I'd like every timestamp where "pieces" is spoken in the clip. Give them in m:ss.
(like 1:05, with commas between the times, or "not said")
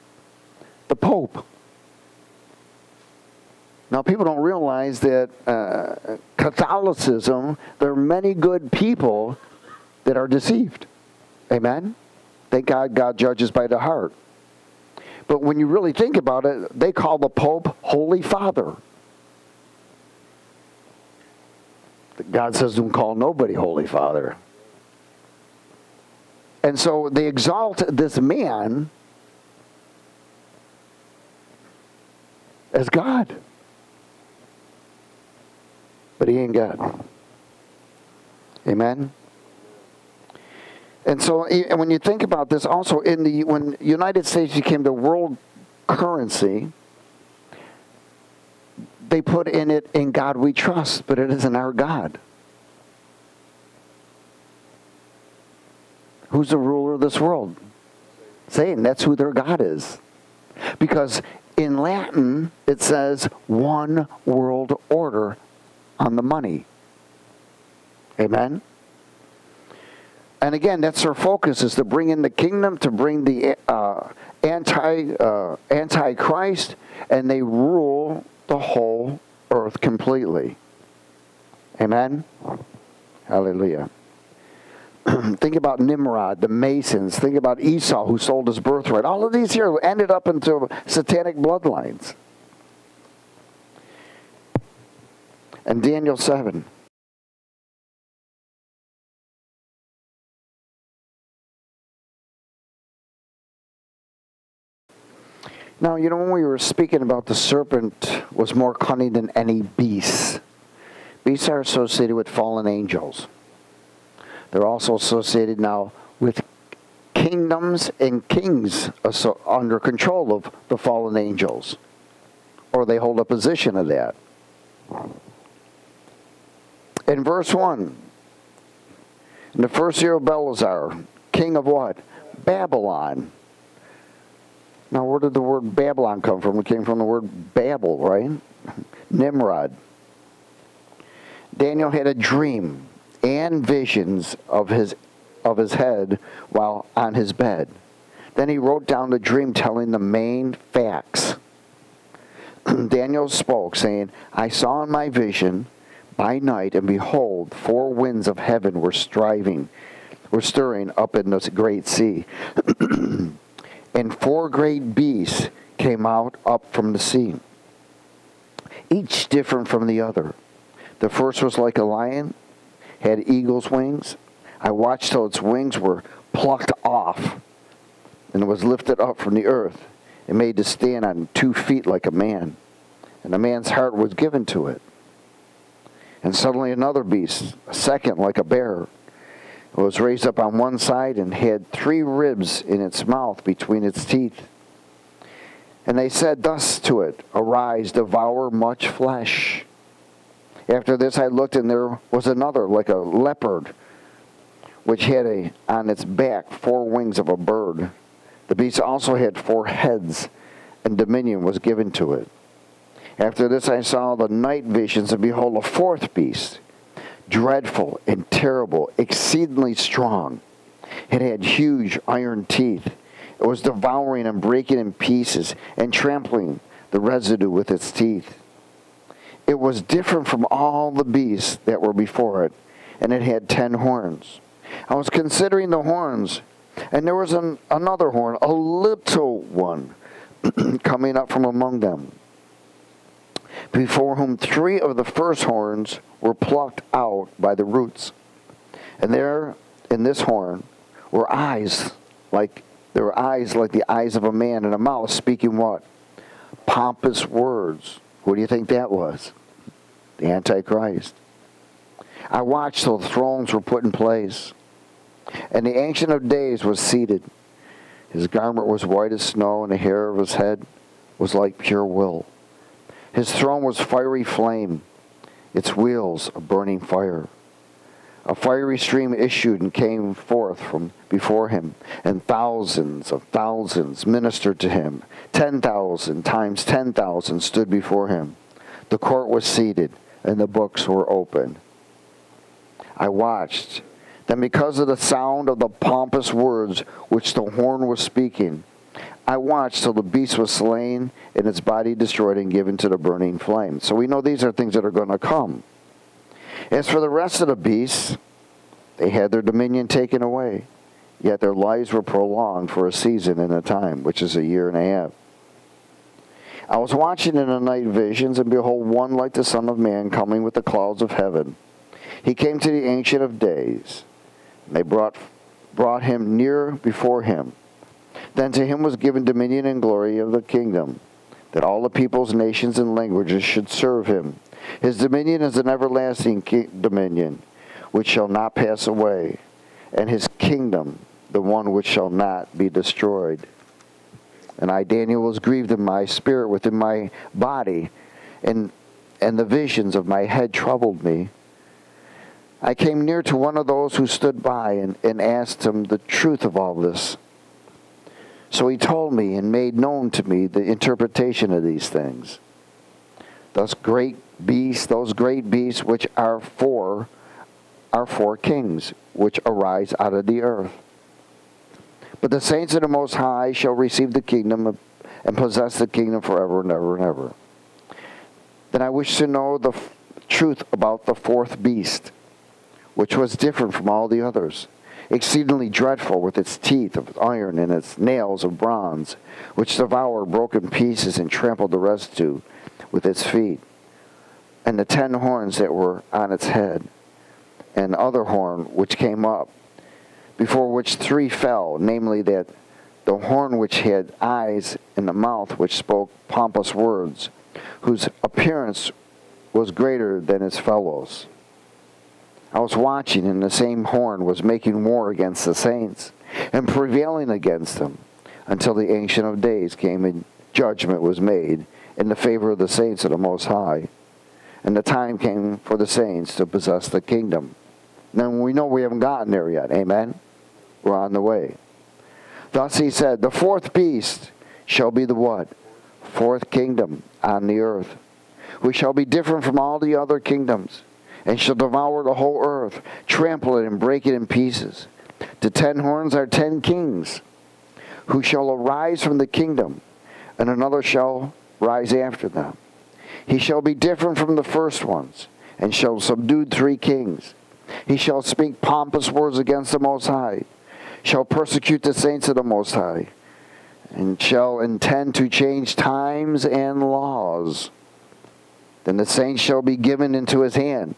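3:44, 6:30, 7:24.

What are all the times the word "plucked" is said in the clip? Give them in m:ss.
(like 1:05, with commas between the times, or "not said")
2:56, 4:06.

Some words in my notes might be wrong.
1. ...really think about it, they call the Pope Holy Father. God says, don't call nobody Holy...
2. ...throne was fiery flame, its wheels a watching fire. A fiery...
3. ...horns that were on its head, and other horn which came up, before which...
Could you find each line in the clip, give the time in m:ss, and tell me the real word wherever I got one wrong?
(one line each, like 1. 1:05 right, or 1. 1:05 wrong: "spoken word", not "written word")
1. 0:15 right
2. 4:33 wrong: "burning", not "watching"
3. 6:35 right.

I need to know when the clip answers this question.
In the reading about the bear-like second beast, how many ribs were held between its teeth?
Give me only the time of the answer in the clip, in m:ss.
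3:11.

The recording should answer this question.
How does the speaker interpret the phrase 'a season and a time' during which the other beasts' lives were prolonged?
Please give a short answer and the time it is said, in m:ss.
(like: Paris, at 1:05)
a year and a half, at 5:14.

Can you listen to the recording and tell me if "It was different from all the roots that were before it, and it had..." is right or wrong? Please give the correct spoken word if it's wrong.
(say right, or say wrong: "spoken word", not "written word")
wrong: "beasts", not "roots".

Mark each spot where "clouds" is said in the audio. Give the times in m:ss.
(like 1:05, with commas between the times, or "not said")
5:20.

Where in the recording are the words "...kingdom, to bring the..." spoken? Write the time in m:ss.
1:12.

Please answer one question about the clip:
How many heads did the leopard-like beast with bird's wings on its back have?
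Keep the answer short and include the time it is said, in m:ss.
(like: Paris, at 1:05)
4, at 3:29.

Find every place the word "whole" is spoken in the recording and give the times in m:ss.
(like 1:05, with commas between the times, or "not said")
1:18, 7:22.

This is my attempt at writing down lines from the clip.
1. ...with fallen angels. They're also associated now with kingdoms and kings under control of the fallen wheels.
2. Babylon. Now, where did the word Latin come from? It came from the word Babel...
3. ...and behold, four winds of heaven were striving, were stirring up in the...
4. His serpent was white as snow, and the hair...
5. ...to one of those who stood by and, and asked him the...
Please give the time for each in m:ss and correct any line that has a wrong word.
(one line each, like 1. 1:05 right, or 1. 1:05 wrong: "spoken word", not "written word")
1. 1:52 wrong: "angels", not "wheels"
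2. 2:12 wrong: "Babylon", not "Latin"
3. 2:36 right
4. 4:28 wrong: "garment", not "serpent"
5. 5:53 right.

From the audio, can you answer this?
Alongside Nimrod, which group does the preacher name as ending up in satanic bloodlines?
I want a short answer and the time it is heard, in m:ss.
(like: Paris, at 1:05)
the Masons, at 1:26.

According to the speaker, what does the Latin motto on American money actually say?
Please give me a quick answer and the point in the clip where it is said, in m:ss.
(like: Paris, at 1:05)
one world order, at 1:03.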